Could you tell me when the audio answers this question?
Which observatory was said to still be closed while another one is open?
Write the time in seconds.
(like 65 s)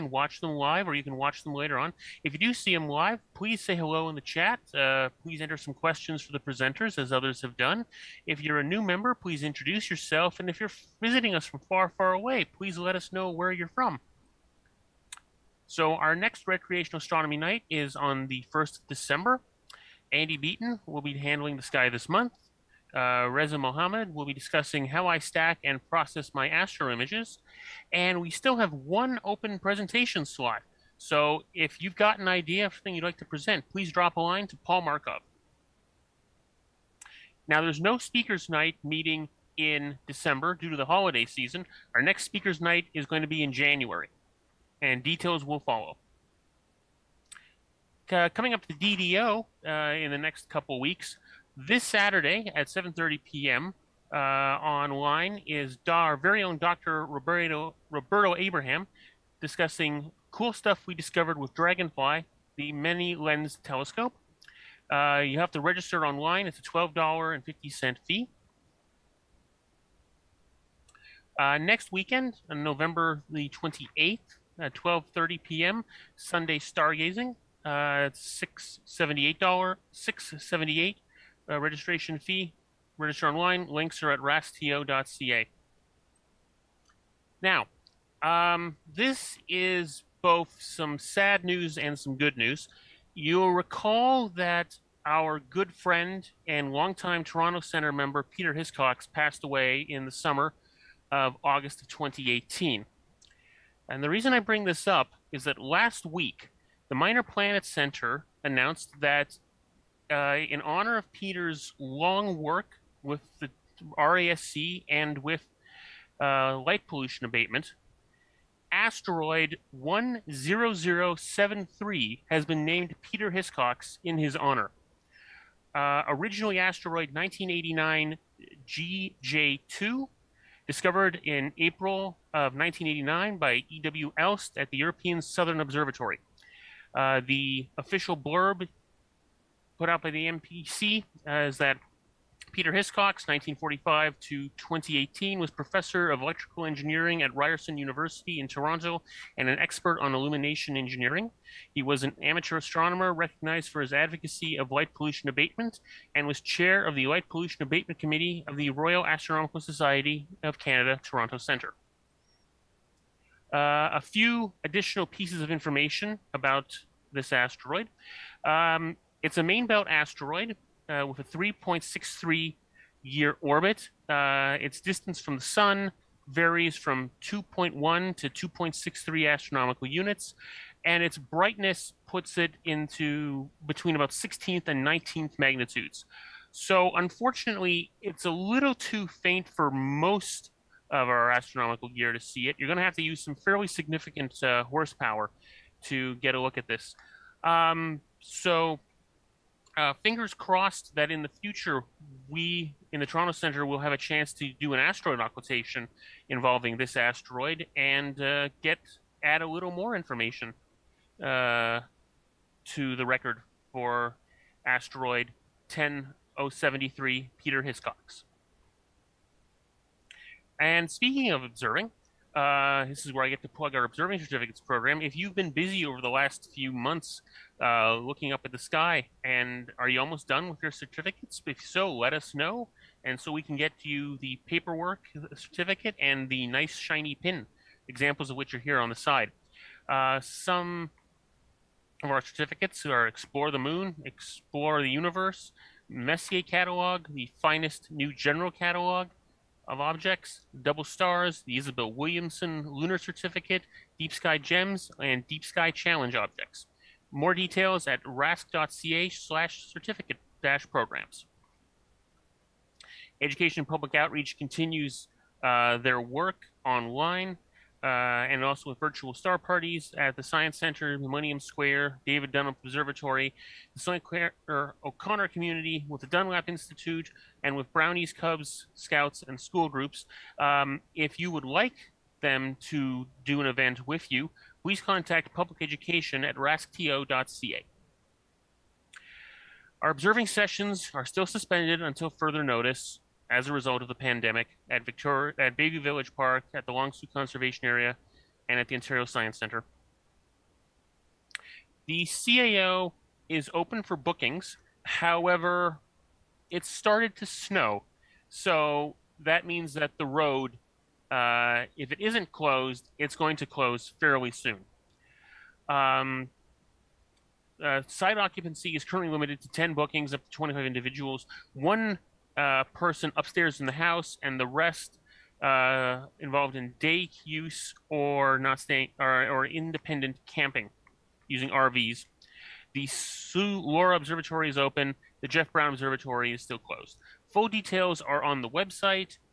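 335 s.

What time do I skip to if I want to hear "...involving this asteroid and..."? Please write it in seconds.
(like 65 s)
206 s.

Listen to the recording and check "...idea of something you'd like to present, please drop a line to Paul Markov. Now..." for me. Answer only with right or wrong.
right.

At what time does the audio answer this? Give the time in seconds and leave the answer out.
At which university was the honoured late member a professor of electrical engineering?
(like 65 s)
147 s.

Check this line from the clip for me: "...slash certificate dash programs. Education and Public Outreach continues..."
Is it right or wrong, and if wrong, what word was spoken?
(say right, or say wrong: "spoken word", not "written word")
right.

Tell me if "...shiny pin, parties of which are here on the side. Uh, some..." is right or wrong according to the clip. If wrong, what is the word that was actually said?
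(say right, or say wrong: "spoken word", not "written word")
wrong: "examples", not "parties".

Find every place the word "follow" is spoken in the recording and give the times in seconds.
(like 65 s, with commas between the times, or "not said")
45 s.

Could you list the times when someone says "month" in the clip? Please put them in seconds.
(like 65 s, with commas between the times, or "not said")
22 s, 226 s.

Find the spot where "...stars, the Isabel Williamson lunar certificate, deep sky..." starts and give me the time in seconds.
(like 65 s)
250 s.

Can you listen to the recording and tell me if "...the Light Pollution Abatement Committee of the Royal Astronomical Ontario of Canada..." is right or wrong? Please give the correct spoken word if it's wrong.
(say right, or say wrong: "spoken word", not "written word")
wrong: "Society", not "Ontario".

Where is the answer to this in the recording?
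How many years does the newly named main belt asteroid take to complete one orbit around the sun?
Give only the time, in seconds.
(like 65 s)
171 s.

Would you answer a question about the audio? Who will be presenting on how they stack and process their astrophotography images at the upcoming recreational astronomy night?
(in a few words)
Reza Mohammed.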